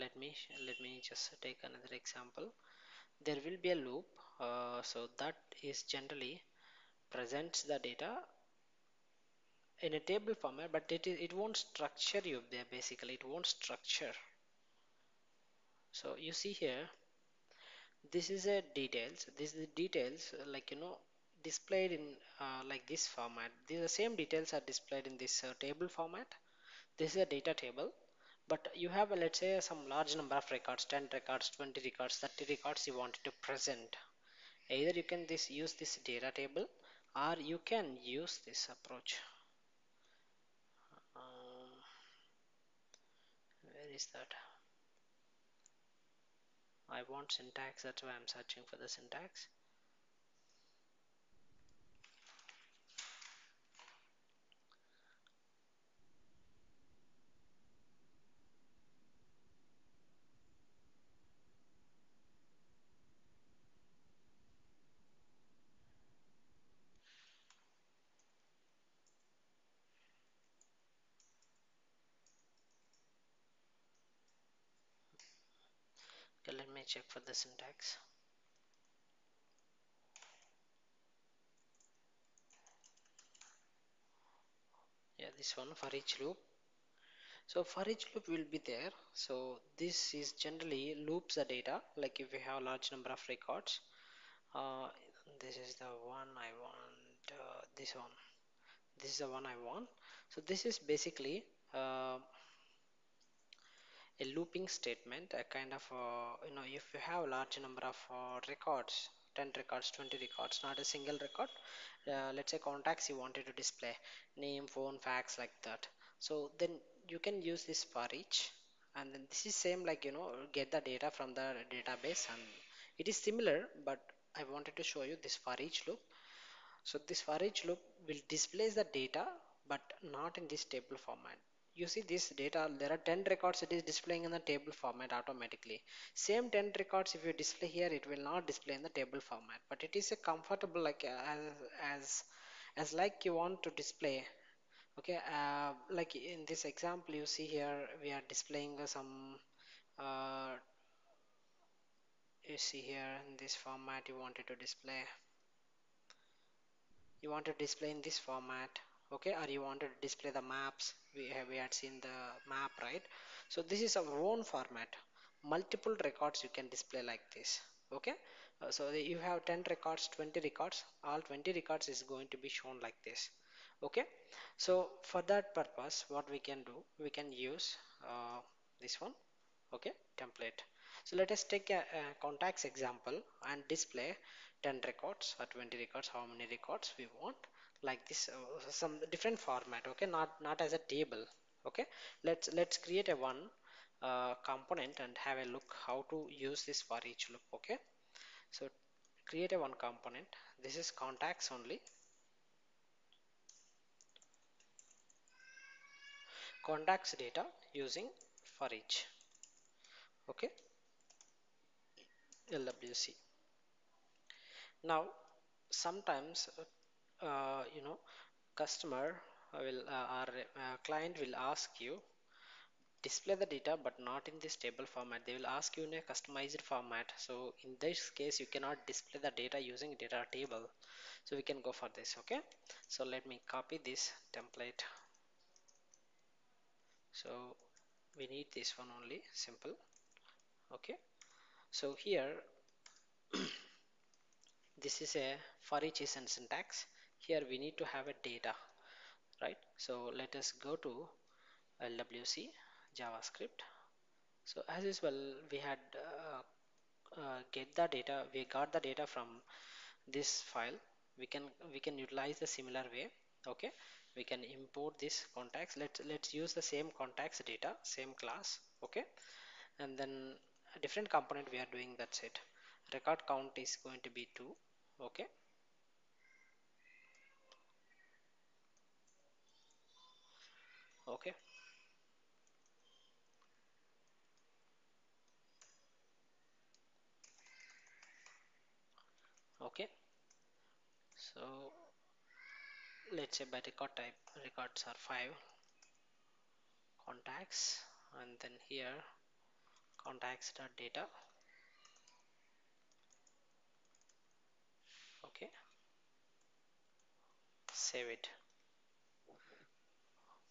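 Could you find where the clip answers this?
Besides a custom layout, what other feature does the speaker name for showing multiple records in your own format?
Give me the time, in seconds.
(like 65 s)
160 s.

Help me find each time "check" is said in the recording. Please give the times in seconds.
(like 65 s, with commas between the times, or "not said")
76 s.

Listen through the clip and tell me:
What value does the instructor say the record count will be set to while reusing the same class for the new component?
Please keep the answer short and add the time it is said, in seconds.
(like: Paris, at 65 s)
2, at 274 s.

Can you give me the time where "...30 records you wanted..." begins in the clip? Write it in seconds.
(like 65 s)
32 s.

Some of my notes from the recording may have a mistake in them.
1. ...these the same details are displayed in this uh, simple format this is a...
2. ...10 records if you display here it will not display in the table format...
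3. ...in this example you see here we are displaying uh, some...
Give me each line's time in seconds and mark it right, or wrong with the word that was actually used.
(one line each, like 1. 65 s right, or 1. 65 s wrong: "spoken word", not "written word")
1. 23 s wrong: "table", not "simple"
2. 136 s right
3. 146 s right.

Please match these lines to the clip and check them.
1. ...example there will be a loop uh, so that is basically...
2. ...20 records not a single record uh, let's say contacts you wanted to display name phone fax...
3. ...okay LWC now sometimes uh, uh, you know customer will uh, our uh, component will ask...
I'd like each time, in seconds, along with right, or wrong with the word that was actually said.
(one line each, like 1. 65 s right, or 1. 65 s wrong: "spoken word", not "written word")
1. 2 s wrong: "generally", not "basically"
2. 109 s right
3. 210 s wrong: "client", not "component".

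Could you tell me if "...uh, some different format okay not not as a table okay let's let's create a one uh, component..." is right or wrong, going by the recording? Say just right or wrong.
right.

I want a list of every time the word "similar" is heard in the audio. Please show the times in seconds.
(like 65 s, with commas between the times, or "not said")
123 s, 262 s.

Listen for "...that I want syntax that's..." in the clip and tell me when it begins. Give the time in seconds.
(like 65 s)
44 s.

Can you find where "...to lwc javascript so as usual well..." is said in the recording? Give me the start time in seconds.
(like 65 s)
250 s.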